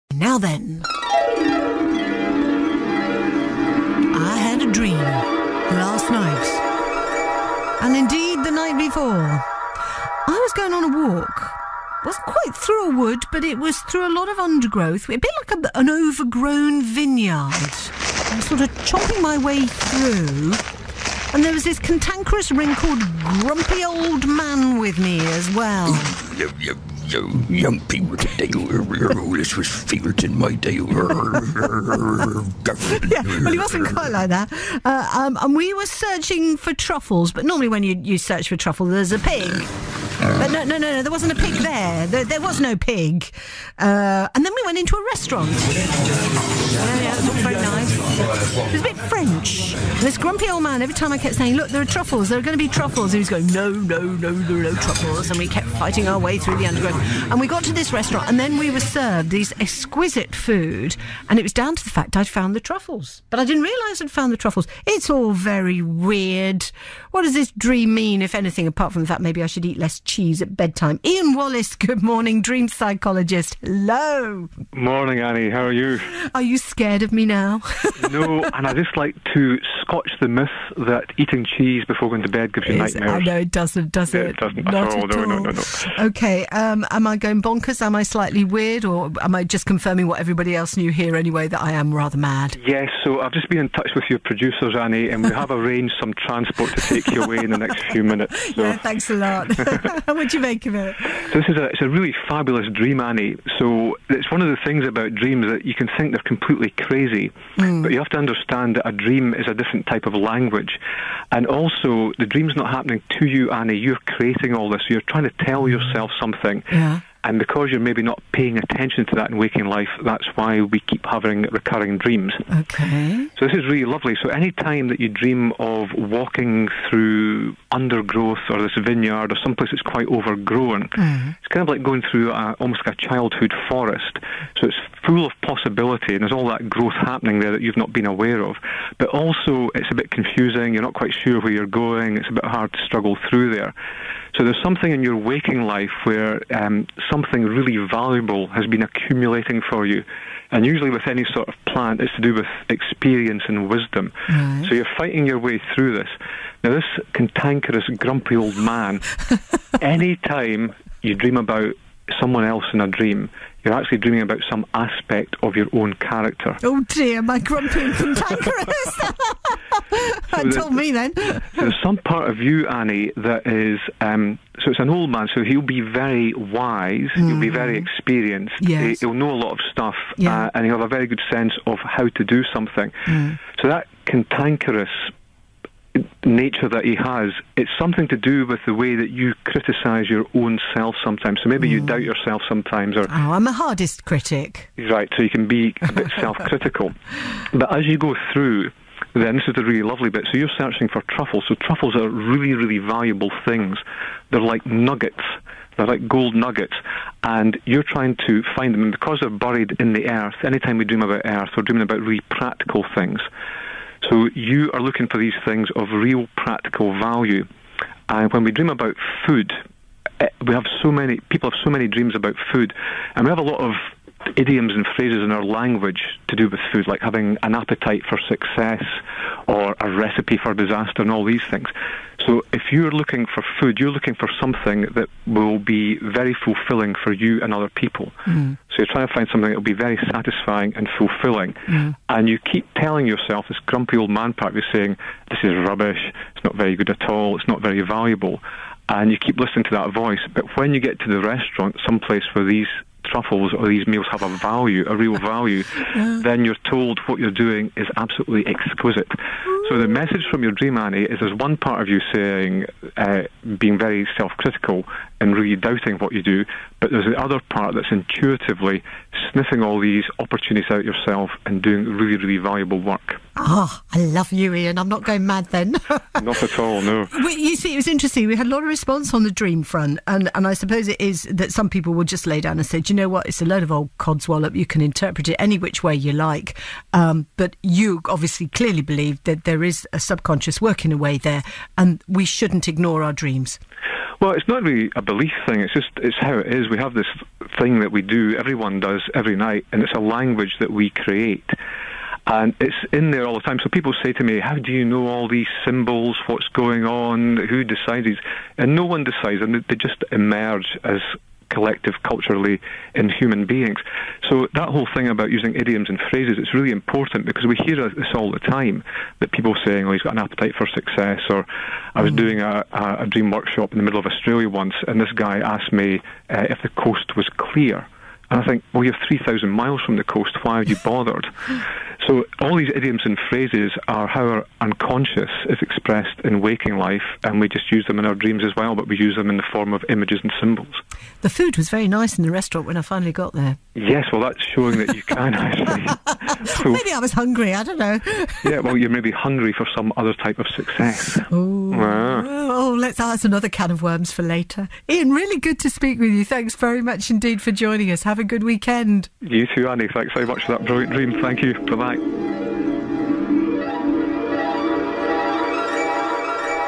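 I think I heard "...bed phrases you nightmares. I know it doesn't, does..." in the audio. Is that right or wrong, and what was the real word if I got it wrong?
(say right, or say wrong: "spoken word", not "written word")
wrong: "gives", not "phrases".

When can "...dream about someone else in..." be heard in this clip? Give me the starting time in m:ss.
2:41.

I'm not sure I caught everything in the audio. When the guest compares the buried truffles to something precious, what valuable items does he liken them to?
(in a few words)
gold nuggets.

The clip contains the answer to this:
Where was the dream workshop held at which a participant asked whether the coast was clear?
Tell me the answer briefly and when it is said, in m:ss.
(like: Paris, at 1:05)
middle of Australia, at 5:23.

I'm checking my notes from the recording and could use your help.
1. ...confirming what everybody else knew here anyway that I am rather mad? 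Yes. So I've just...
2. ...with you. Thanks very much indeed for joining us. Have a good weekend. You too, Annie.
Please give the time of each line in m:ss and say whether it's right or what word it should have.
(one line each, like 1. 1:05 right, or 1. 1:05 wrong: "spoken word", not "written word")
1. 1:29 right
2. 5:55 right.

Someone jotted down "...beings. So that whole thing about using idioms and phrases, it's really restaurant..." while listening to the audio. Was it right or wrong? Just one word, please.
wrong.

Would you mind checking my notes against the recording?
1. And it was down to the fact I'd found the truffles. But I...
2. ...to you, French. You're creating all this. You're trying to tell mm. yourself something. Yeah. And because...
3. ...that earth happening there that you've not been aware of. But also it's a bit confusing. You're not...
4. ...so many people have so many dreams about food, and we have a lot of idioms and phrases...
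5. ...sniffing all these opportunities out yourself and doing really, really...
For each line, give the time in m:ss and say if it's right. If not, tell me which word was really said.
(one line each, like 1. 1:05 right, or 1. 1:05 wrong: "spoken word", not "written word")
1. 1:01 right
2. 1:53 wrong: "Annie", not "French"
3. 2:16 wrong: "growth", not "earth"
4. 3:40 right
5. 4:29 right.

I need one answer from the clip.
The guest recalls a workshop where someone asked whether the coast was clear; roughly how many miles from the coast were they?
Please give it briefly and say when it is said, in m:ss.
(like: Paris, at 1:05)
3,000, at 5:29.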